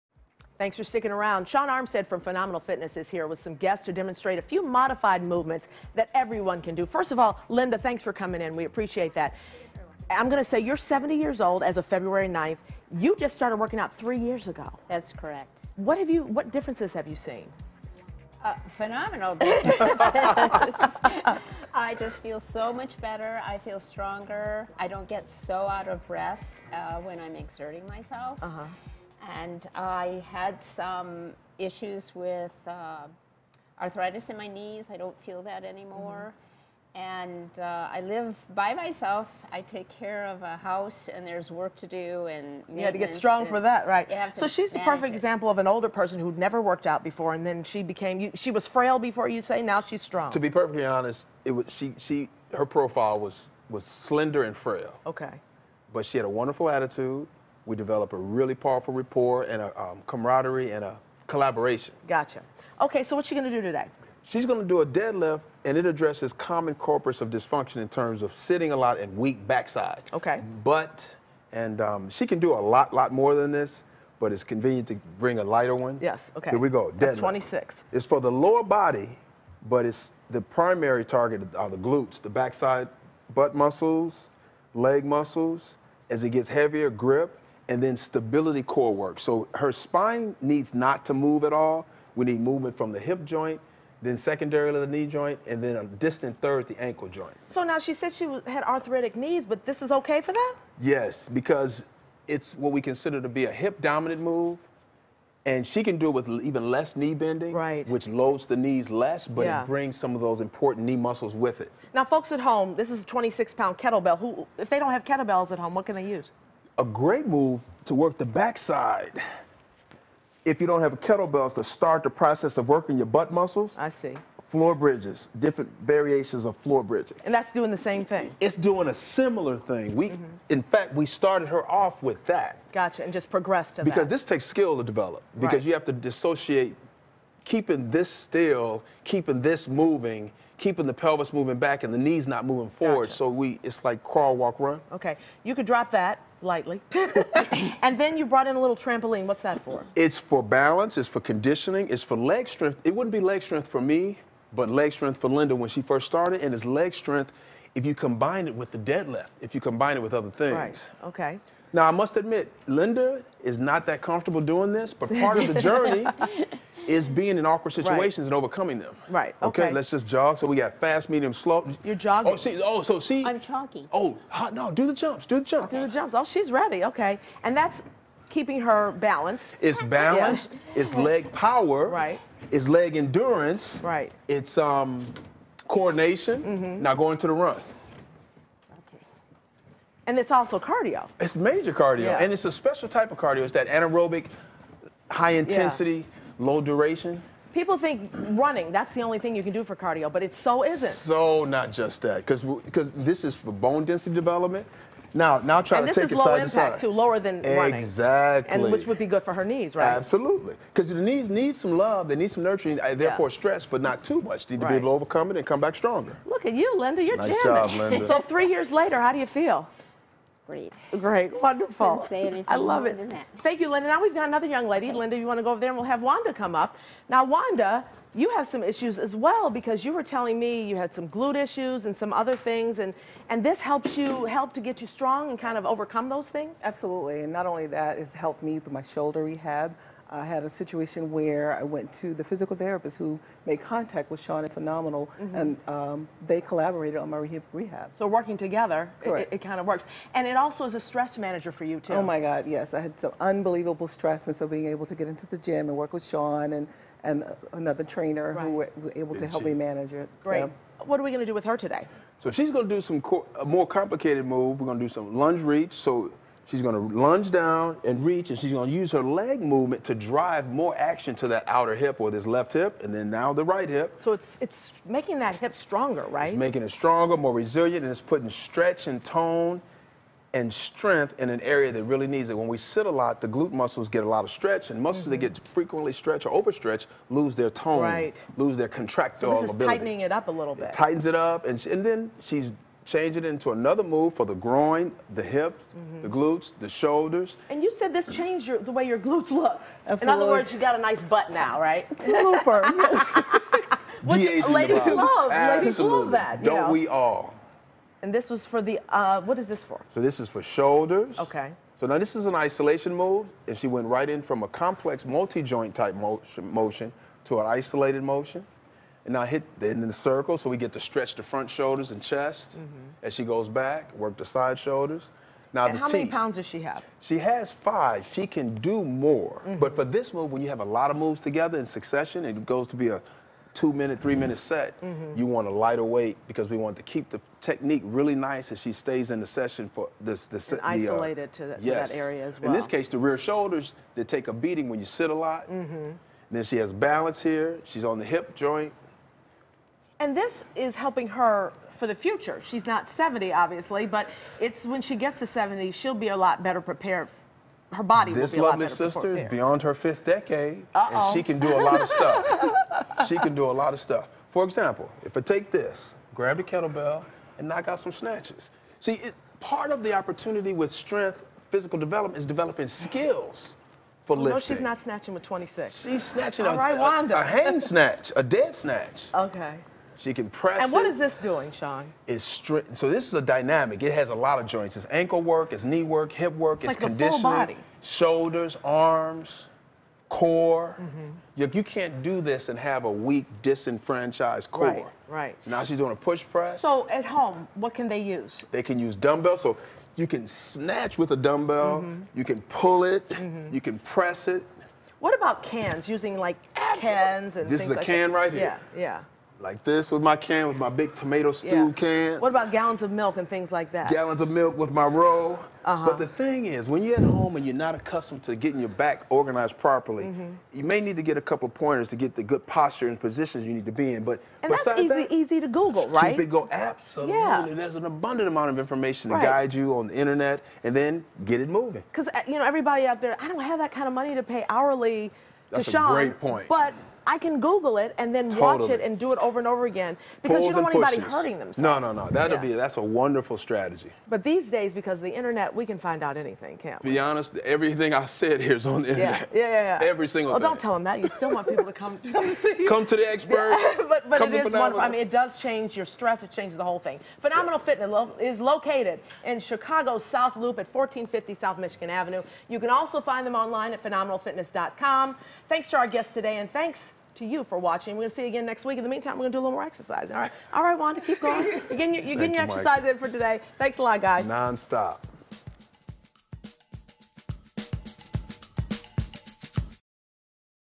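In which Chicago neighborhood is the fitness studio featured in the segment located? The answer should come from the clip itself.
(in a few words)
South Loop.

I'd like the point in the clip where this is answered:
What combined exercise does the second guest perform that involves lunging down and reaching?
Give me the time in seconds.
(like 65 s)
265 s.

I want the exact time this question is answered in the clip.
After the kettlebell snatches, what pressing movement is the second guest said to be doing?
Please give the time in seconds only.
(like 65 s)
395 s.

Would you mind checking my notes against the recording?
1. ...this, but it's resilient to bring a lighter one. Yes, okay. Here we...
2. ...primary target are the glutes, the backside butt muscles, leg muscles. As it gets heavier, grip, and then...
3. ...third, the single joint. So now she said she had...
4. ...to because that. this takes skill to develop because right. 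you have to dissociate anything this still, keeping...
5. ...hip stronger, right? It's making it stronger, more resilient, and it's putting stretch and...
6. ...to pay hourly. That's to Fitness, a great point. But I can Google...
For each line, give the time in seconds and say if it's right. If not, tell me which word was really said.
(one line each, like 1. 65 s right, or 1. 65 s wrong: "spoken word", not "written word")
1. 73 s wrong: "convenient", not "resilient"
2. 80 s right
3. 96 s wrong: "ankle", not "single"
4. 133 s wrong: "keeping", not "anything"
5. 275 s right
6. 434 s wrong: "Sean", not "Fitness".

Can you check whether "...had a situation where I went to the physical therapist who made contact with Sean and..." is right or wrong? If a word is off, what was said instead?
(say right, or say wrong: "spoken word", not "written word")
right.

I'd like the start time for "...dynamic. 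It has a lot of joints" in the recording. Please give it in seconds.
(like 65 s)
383 s.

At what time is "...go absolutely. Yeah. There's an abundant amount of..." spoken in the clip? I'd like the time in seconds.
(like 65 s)
426 s.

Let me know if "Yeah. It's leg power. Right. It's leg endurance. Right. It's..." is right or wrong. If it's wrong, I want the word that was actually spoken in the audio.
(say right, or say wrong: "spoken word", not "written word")
right.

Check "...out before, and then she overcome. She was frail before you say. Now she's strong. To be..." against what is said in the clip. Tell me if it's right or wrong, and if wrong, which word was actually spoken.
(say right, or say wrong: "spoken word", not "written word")
wrong: "became", not "overcome".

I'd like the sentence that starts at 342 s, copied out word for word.
In this case, the rear shoulders, they take a beating when you sit a lot.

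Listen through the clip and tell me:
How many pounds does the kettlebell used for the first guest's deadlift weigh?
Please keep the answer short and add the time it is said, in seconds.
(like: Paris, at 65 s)
26, at 113 s.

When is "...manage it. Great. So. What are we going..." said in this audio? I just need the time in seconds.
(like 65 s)
259 s.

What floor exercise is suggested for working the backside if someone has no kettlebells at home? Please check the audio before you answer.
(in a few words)
Floor bridges.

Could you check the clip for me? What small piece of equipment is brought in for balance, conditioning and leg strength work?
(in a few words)
trampoline.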